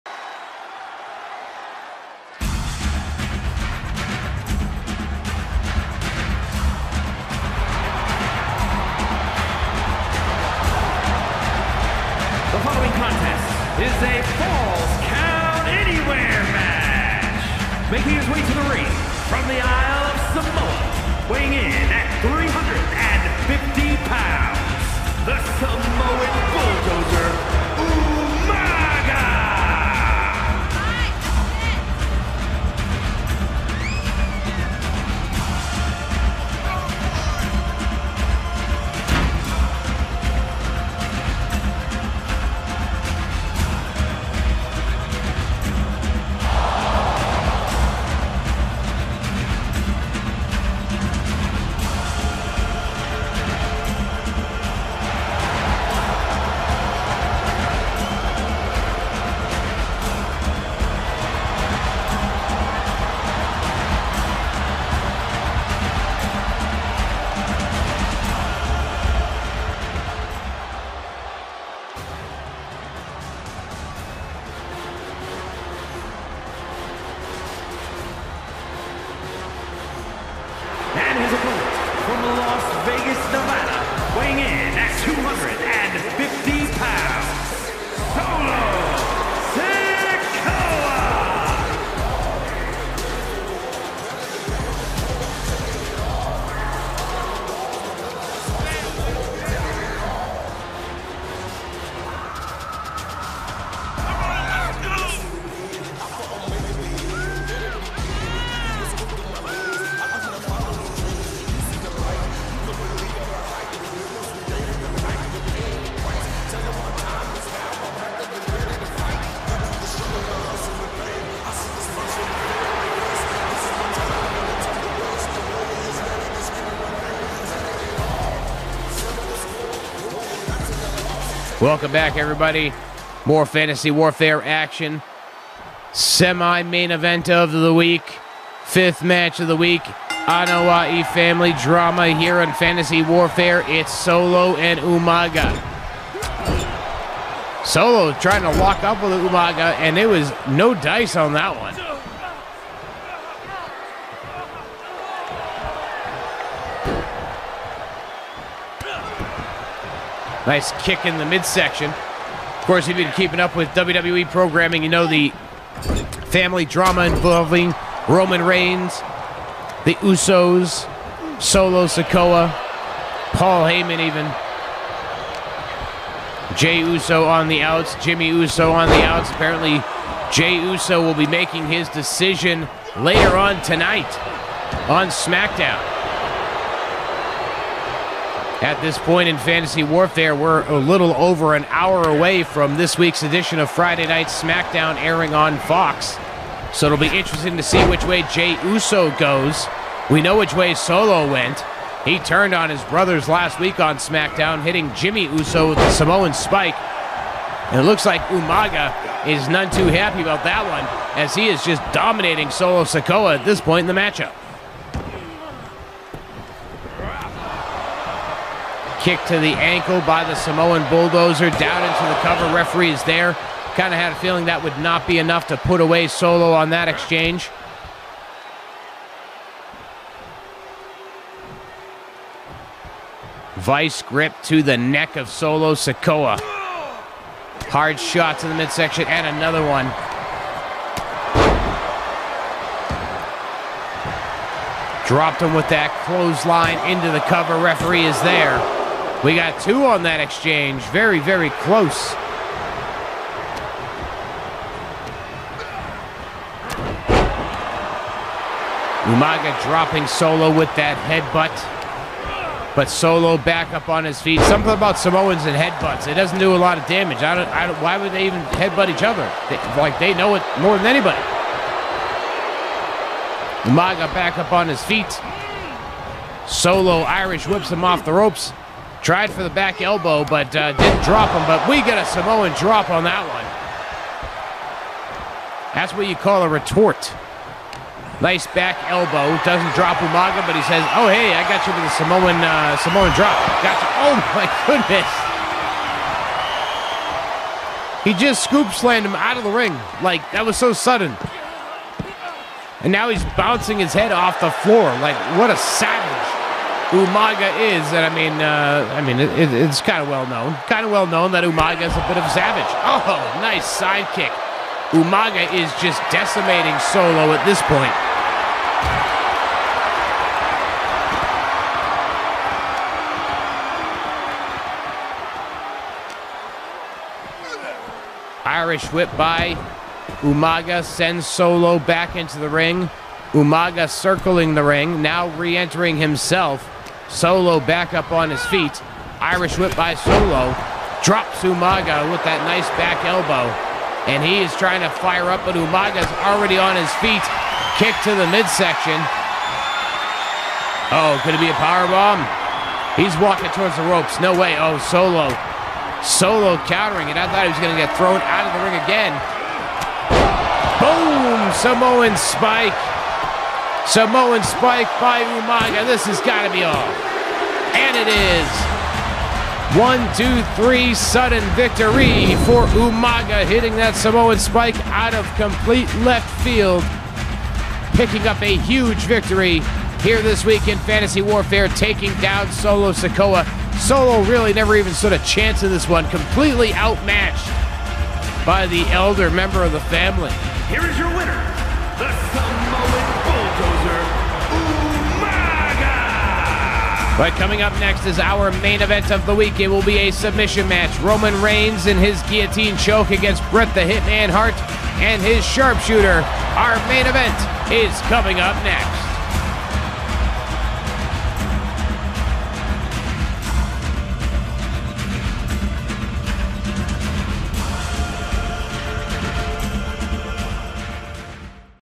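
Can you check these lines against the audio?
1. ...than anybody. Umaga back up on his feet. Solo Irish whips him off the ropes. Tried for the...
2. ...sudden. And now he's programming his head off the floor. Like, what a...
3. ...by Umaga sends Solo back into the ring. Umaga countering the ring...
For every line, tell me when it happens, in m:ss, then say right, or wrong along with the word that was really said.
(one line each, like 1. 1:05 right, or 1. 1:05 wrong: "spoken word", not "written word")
1. 4:30 right
2. 5:00 wrong: "bouncing", not "programming"
3. 5:29 wrong: "circling", not "countering".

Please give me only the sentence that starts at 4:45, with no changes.
That's what you call a retort.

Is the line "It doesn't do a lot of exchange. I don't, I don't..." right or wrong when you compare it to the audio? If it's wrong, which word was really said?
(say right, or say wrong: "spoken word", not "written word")
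wrong: "damage", not "exchange".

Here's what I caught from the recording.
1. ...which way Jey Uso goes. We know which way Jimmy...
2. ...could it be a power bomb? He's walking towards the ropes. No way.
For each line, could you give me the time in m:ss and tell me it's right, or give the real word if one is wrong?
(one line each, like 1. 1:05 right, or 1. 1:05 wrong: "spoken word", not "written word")
1. 3:17 wrong: "Solo", not "Jimmy"
2. 5:51 right.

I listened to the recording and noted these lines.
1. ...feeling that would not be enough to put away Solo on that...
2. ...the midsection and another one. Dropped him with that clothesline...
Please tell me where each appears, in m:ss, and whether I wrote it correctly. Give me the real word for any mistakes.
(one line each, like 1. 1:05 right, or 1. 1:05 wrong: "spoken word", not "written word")
1. 3:44 right
2. 3:58 right.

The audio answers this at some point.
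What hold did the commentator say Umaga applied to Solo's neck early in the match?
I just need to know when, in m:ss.
3:53.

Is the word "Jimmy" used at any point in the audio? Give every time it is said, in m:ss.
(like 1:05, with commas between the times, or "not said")
2:58, 3:24.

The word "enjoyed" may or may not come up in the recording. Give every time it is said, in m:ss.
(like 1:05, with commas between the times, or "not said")
not said.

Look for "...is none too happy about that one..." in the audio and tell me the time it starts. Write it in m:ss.
3:29.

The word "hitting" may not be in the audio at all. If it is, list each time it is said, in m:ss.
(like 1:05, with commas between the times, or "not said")
3:24, 6:13.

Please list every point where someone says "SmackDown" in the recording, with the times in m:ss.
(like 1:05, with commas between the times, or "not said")
3:05, 3:14, 3:23.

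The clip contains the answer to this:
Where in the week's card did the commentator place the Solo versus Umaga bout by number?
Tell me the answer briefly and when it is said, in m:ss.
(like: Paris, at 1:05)
Fifth match, at 2:18.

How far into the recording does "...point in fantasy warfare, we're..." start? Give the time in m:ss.
3:08.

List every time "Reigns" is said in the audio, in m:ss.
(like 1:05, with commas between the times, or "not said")
2:48, 6:41.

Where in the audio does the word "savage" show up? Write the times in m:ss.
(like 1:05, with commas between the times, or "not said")
5:05, 5:12.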